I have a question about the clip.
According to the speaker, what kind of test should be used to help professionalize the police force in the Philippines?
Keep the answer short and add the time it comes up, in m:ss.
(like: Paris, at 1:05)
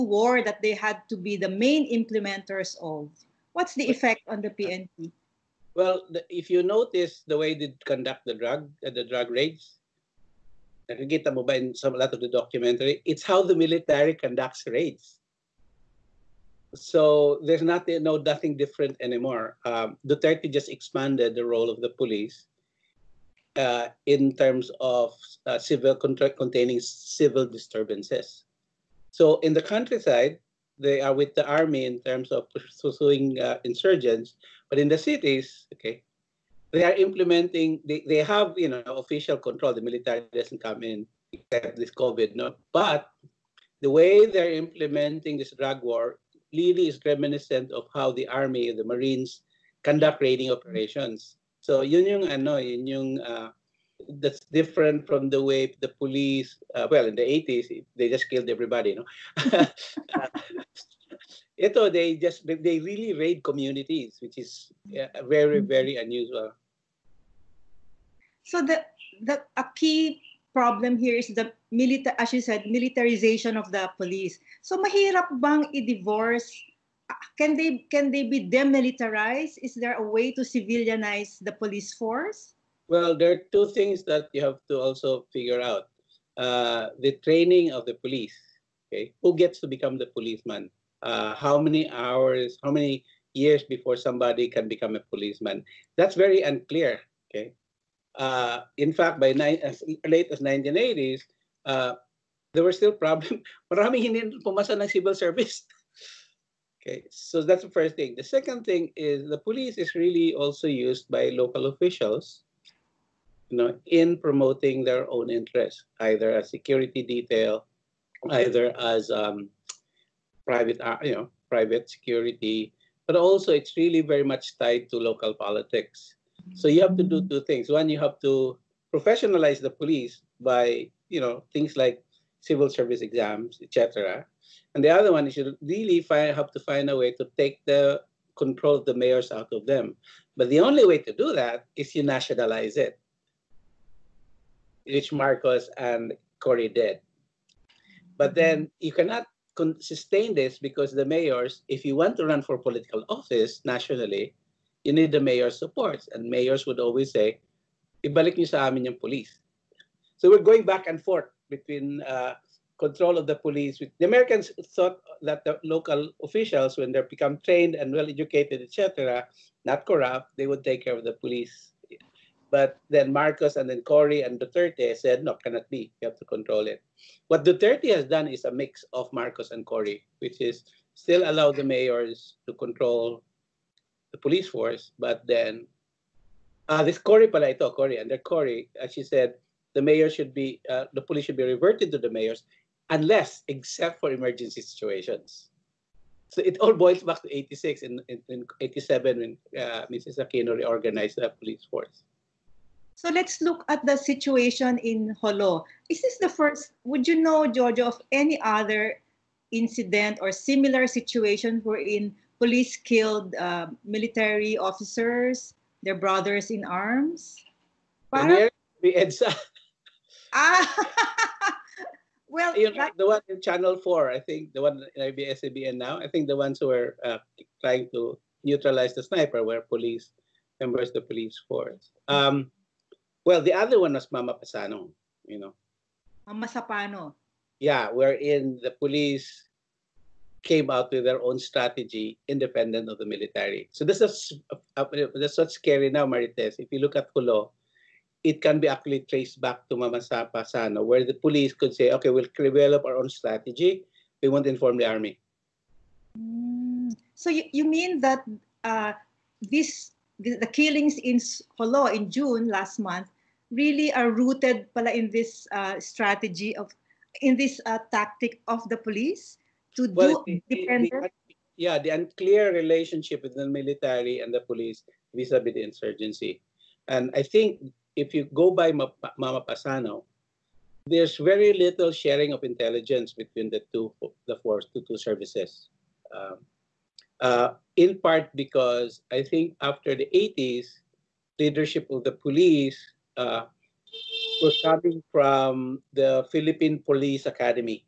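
civil service exams, at 2:12.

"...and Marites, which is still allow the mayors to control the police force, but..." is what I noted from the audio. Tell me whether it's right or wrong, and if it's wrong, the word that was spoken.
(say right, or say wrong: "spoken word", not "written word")
wrong: "Cory", not "Marites".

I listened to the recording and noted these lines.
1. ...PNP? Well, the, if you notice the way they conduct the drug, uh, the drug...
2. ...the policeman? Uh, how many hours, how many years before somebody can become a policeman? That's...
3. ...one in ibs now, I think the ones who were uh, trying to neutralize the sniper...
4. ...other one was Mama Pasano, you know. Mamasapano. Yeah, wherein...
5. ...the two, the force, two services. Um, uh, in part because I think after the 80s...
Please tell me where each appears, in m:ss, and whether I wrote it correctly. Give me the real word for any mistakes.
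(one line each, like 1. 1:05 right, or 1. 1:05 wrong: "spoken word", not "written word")
1. 0:04 right
2. 1:29 right
3. 3:44 right
4. 3:53 right
5. 4:43 right.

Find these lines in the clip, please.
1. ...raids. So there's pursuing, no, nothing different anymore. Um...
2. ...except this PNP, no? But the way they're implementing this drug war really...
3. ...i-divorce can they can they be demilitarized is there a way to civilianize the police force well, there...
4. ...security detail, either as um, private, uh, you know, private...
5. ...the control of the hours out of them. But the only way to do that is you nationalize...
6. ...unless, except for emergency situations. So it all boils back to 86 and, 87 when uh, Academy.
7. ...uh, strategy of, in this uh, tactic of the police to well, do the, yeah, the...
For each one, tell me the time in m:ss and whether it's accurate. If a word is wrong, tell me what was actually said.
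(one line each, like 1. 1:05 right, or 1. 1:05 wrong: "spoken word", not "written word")
1. 0:14 wrong: "nothing", not "pursuing"
2. 0:41 wrong: "COVID", not "PNP"
3. 1:15 right
4. 1:56 right
5. 2:17 wrong: "mayors", not "hours"
6. 3:12 wrong: "Mrs", not "Academy"
7. 4:25 right.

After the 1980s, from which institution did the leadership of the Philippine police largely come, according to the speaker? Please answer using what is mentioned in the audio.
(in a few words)
Philippine Police Academy.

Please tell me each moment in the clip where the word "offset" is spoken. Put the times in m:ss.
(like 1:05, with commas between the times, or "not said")
not said.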